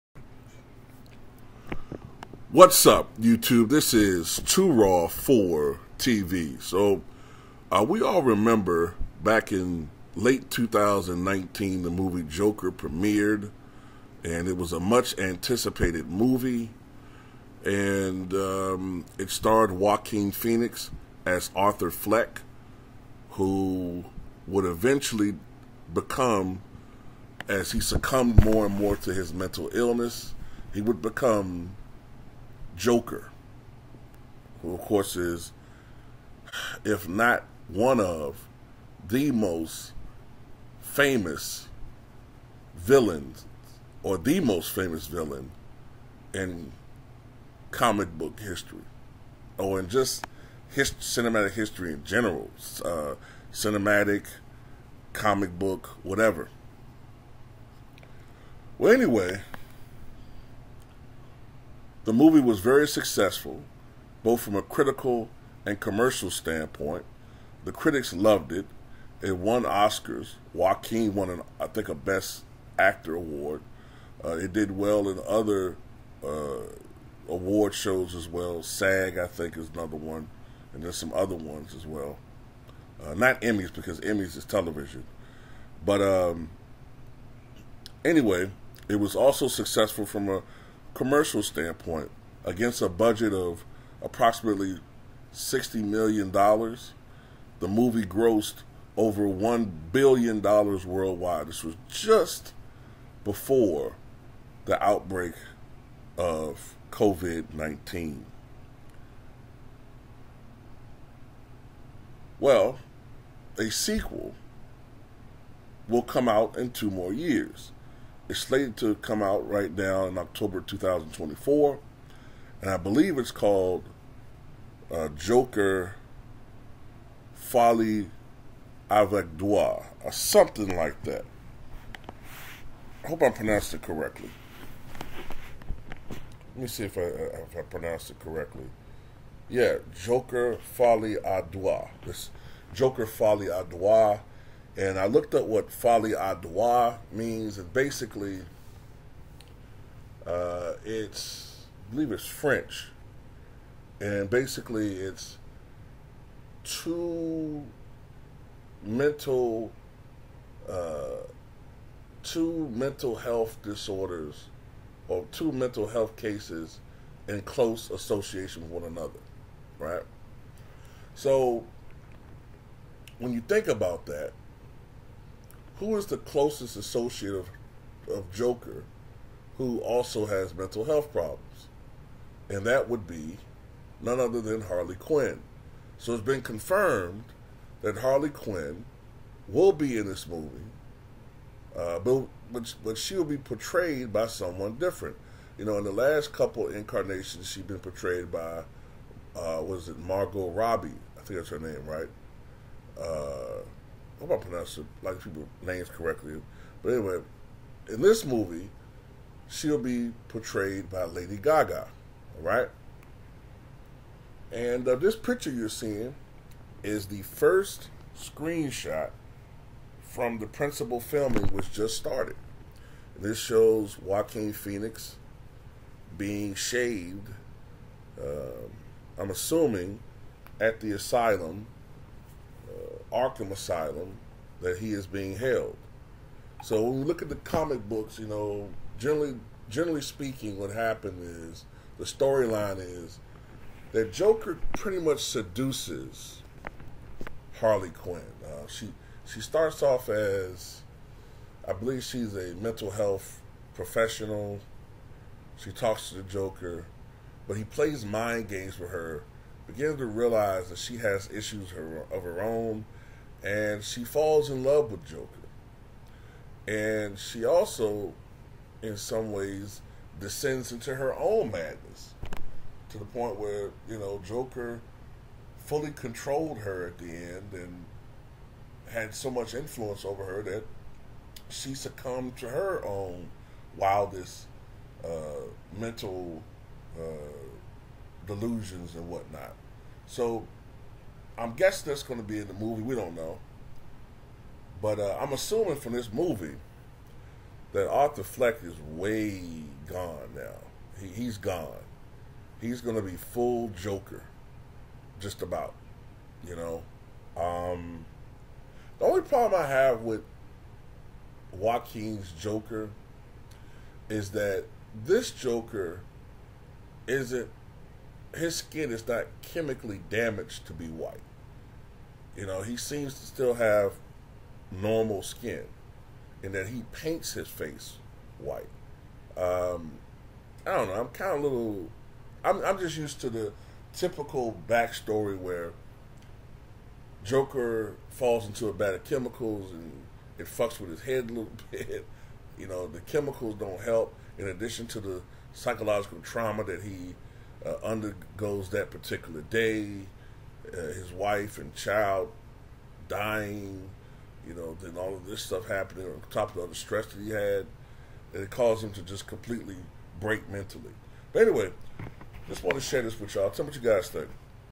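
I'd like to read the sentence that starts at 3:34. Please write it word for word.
And uh, this picture you're seeing is the first screenshot from the principal filming, which just started.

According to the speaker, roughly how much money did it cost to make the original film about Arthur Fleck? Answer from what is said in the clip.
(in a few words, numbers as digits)
$60 million.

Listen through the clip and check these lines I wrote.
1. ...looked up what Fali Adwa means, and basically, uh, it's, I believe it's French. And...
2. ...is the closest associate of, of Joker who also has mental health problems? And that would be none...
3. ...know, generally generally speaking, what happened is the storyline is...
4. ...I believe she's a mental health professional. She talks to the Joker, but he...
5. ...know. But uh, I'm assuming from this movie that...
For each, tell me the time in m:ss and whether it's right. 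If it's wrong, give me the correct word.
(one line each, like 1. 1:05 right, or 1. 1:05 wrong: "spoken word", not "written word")
1. 2:25 right
2. 2:55 right
3. 3:58 right
4. 4:11 right
5. 4:53 right.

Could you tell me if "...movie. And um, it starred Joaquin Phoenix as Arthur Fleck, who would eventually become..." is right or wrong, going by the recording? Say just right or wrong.
right.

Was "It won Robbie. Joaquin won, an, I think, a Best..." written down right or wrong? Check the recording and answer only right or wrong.
wrong.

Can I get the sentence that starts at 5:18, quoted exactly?
His skin is not chemically damaged to be white.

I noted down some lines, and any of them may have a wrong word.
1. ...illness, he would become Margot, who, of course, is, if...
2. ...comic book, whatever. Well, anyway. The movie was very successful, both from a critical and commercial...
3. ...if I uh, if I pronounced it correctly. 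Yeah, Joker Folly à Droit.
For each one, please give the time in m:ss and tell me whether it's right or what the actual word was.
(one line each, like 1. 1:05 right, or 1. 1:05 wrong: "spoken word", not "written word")
1. 0:29 wrong: "Joker", not "Margot"
2. 0:55 right
3. 2:16 right.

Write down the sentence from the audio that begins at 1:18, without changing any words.
SAG, I think, is another one, and there's some other ones as well.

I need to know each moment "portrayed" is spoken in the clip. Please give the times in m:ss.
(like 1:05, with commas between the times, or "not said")
3:13, 3:17, 3:30.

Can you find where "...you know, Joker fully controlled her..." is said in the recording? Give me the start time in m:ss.
4:33.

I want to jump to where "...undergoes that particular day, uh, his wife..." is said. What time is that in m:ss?
5:47.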